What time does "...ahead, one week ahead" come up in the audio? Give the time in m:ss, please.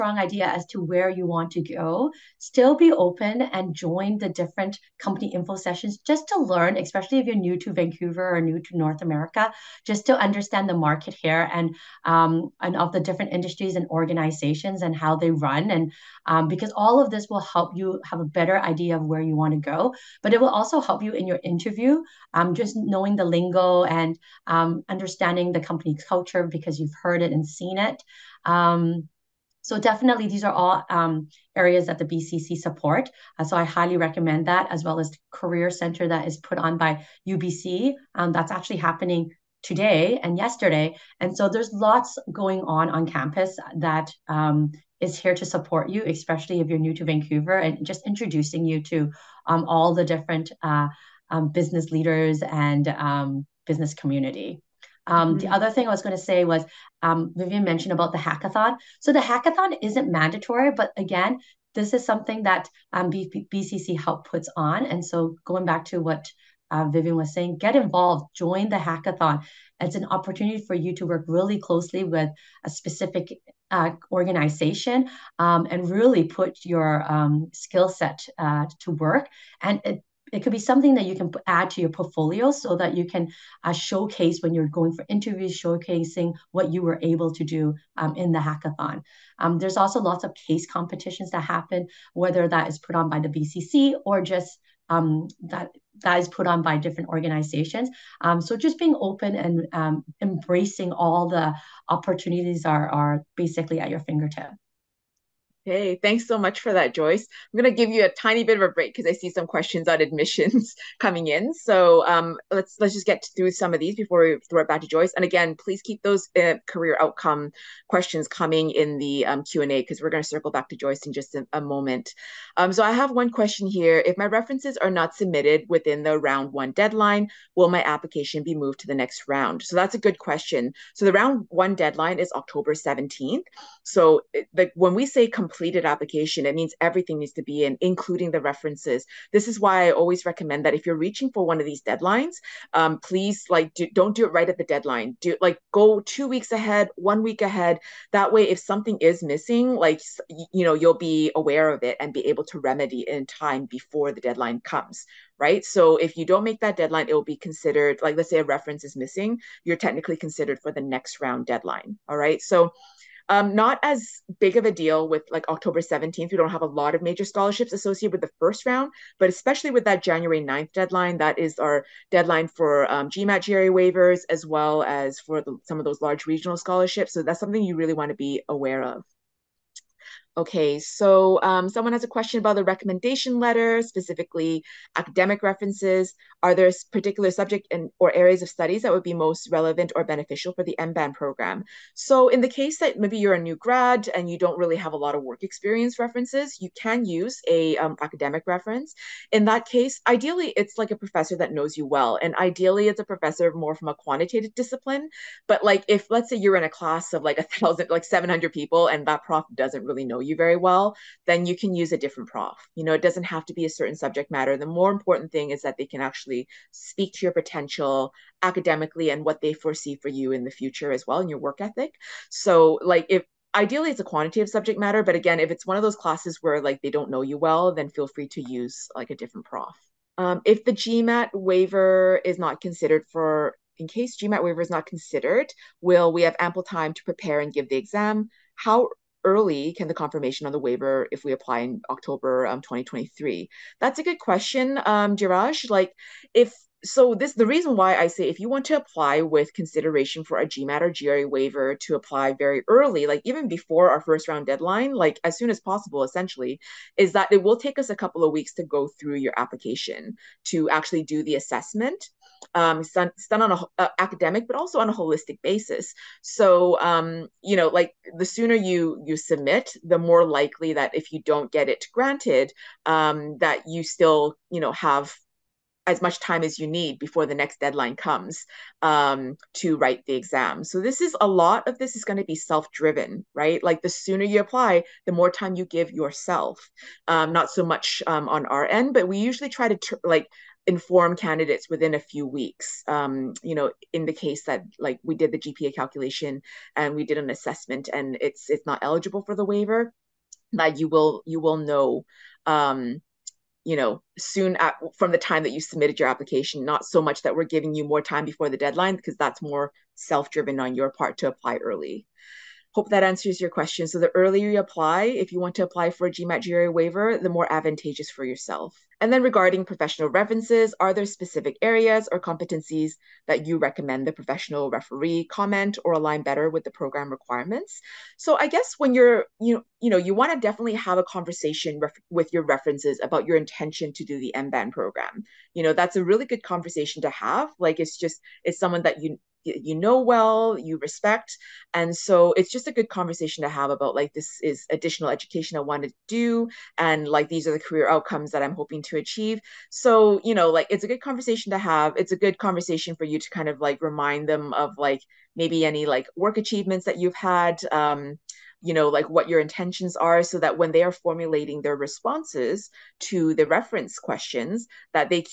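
2:26.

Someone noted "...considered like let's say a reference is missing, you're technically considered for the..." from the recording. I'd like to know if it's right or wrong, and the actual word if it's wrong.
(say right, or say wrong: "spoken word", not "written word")
right.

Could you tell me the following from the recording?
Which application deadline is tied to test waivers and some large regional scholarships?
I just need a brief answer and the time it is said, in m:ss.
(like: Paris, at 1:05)
January 9th, at 2:50.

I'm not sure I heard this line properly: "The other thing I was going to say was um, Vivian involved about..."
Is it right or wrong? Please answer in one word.
wrong.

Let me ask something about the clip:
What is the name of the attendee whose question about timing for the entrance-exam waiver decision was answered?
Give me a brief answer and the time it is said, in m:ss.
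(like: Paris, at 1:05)
Jiraj, at 4:05.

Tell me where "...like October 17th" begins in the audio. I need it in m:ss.
2:45.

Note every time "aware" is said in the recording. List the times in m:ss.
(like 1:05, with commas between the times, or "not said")
2:31, 2:58.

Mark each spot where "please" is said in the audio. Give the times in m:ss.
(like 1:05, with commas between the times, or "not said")
1:55, 2:22.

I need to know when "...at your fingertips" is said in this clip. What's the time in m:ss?
1:43.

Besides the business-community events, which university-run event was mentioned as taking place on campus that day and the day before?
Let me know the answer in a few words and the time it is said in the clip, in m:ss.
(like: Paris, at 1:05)
Career Center, at 0:35.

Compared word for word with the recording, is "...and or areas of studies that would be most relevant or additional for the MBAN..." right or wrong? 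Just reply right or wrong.
wrong.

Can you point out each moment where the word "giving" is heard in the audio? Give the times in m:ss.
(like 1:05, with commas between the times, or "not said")
5:07.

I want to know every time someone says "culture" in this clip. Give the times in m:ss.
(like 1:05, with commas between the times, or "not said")
0:26.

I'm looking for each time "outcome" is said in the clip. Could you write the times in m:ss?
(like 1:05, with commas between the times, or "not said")
1:56, 5:47.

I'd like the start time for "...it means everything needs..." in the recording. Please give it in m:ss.
2:16.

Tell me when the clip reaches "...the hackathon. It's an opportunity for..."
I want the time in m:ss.
1:08.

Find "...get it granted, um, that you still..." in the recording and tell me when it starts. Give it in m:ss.
4:31.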